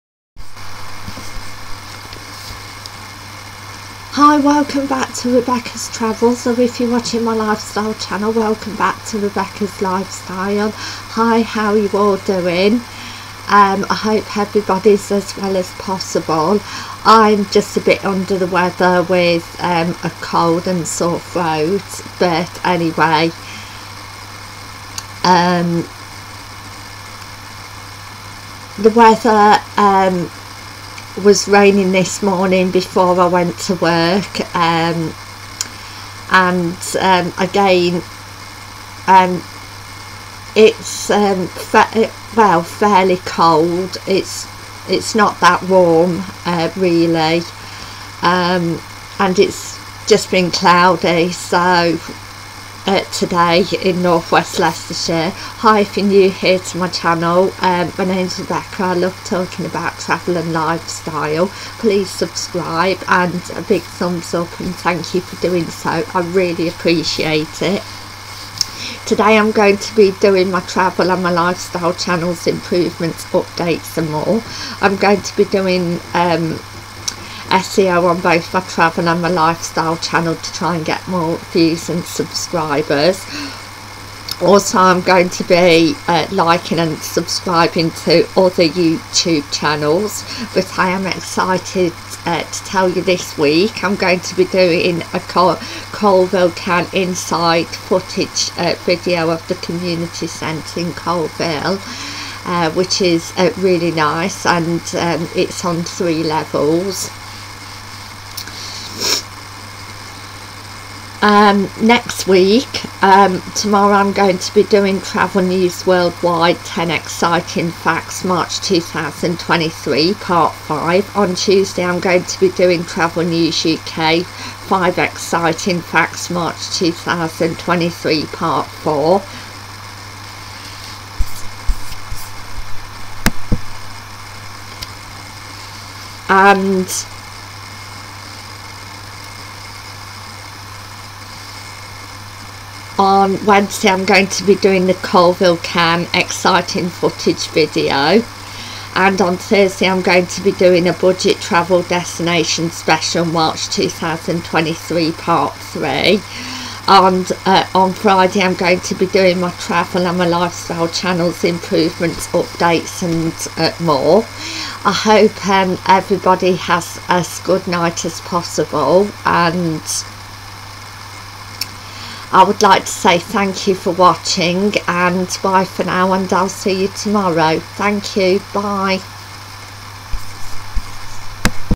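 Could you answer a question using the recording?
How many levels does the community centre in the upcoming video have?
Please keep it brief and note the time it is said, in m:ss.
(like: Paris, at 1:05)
3, at 1:45.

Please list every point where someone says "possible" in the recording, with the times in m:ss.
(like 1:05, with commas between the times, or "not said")
0:15, 2:48.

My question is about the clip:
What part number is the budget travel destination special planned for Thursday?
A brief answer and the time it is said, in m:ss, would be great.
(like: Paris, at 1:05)
Part 3, at 2:35.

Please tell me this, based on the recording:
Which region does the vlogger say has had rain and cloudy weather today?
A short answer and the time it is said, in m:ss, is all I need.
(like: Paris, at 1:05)
Northwest Leicestershire, at 0:54.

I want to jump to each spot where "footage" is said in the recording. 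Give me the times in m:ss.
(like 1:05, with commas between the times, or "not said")
1:37, 2:26.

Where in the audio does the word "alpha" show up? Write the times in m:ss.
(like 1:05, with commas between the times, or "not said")
not said.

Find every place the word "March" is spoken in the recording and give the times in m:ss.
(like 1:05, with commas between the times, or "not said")
1:58, 2:06, 2:33.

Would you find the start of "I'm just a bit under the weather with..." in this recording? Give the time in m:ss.
0:17.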